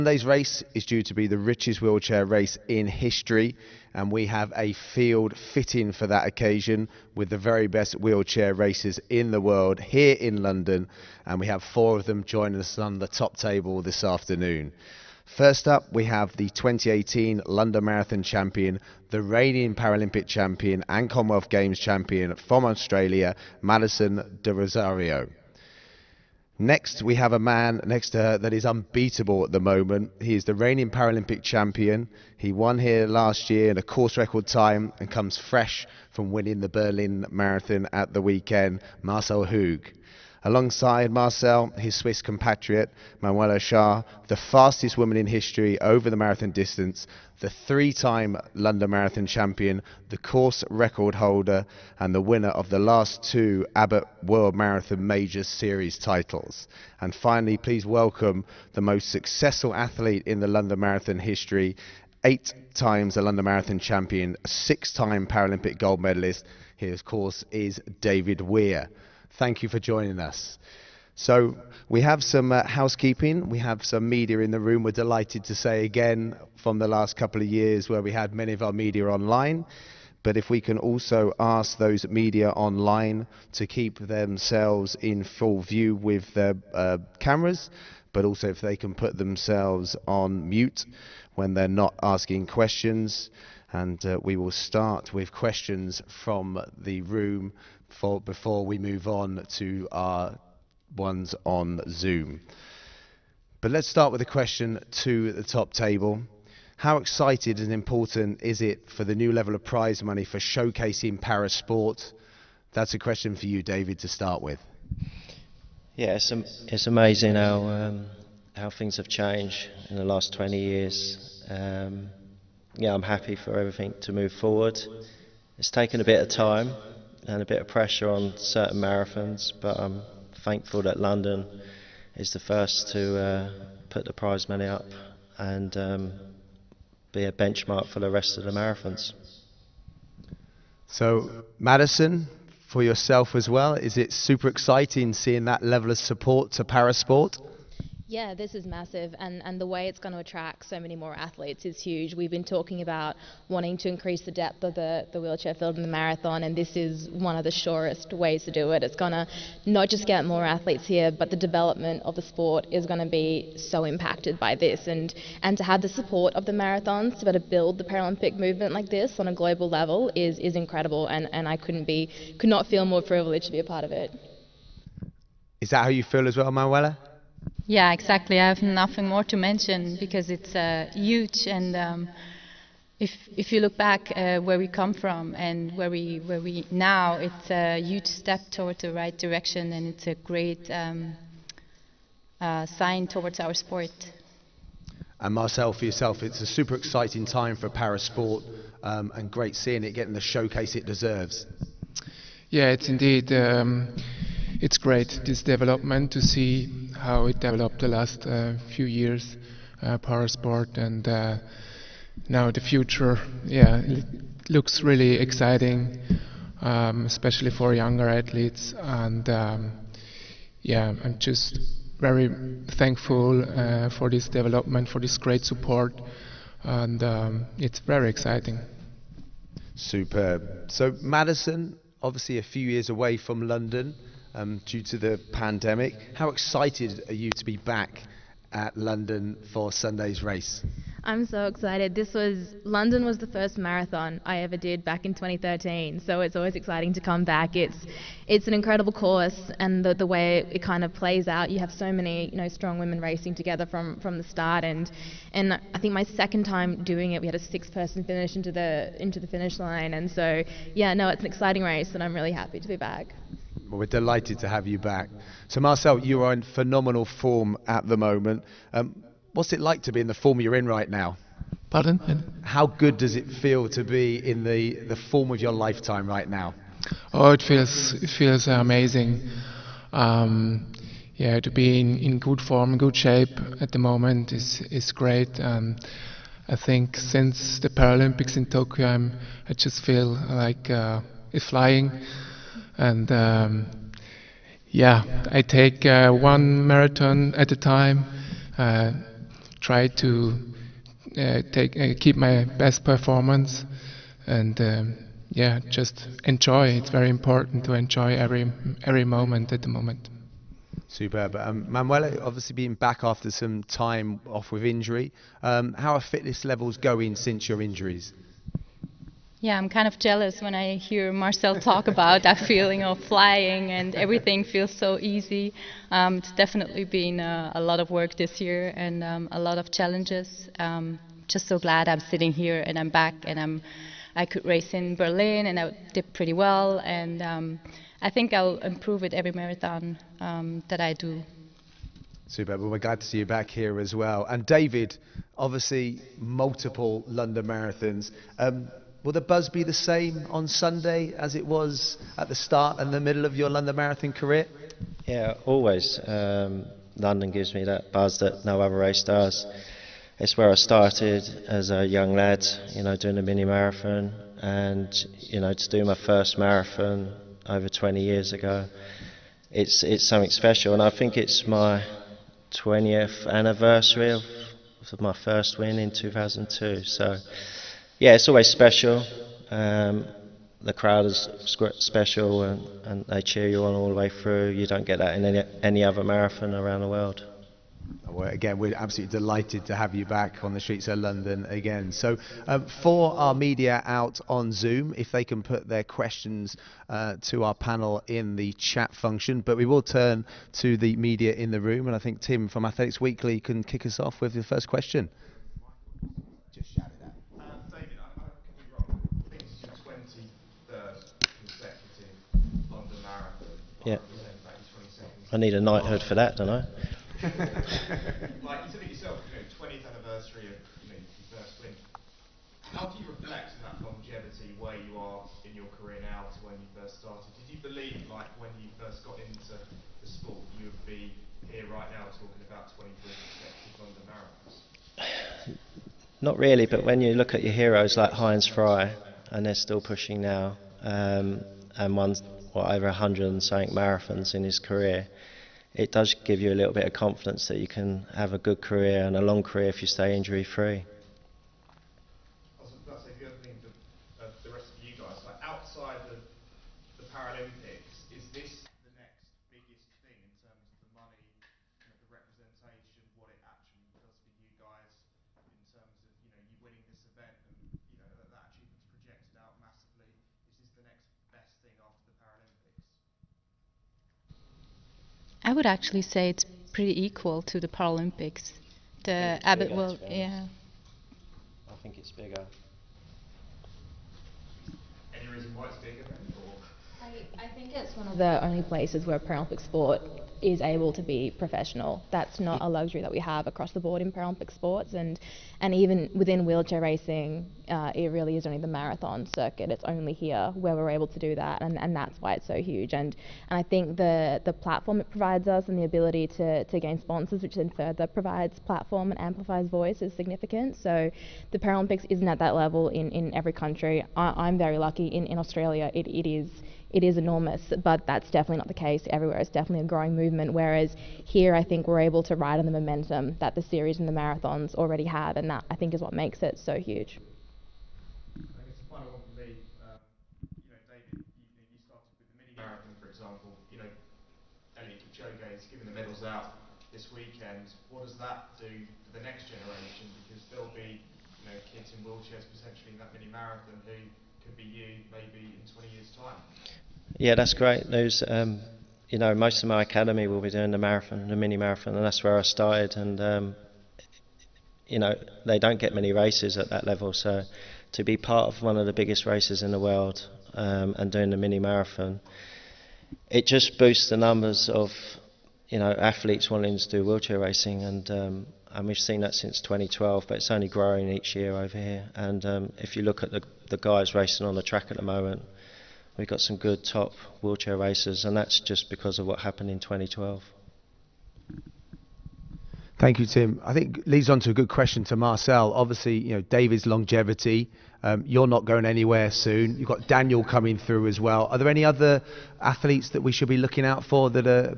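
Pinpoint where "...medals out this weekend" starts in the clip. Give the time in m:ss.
8:55.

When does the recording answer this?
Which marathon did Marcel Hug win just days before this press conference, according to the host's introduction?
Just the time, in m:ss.
0:36.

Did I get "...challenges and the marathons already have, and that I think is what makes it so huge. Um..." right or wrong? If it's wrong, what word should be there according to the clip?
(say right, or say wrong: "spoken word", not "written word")
wrong: "series", not "challenges".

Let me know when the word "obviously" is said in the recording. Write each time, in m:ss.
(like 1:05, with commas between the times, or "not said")
3:52, 5:12, 5:45, 9:45.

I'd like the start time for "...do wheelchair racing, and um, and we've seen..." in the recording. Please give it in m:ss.
9:26.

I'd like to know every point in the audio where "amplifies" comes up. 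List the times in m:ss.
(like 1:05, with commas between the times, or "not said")
8:29.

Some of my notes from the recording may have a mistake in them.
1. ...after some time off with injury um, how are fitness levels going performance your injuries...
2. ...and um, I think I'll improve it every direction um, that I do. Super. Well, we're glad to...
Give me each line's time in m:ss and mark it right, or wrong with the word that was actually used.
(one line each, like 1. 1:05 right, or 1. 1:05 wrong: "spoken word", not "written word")
1. 5:13 wrong: "since", not "performance"
2. 5:36 wrong: "marathon", not "direction".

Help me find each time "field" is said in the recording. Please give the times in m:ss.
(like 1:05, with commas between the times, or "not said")
0:04, 2:35.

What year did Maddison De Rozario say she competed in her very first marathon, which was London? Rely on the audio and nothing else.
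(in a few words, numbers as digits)
2013.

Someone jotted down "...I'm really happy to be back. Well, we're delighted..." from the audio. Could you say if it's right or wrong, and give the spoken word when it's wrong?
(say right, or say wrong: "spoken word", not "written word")
right.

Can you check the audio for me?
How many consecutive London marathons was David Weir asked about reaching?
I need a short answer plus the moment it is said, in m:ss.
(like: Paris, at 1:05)
23, at 7:12.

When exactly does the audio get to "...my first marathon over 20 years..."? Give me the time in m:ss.
6:05.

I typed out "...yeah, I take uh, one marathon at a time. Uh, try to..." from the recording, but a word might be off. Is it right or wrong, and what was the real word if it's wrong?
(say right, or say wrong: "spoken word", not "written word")
right.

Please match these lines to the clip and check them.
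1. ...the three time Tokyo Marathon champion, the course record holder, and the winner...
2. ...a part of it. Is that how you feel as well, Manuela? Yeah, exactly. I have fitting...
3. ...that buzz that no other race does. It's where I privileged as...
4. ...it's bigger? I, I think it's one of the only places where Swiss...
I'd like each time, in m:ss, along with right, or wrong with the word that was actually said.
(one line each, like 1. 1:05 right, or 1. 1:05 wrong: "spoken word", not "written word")
1. 0:47 wrong: "London", not "Tokyo"
2. 2:53 wrong: "nothing", not "fitting"
3. 5:57 wrong: "started", not "privileged"
4. 8:05 wrong: "Paralympic", not "Swiss".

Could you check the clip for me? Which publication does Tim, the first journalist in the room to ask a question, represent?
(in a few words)
Athletics Weekly.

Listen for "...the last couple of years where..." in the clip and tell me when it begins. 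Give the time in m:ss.
1:16.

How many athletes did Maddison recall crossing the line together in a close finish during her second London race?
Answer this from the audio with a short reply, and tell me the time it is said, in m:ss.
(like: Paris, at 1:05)
6, at 4:17.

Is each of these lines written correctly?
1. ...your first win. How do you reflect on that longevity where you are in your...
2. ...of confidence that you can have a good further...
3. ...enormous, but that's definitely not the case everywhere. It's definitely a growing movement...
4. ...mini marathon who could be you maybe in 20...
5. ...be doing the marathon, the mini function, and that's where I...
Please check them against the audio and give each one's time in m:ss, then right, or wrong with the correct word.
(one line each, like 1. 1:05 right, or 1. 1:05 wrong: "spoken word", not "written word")
1. 7:00 right
2. 7:26 wrong: "career", not "further"
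3. 8:37 right
4. 9:03 right
5. 9:10 wrong: "marathon", not "function".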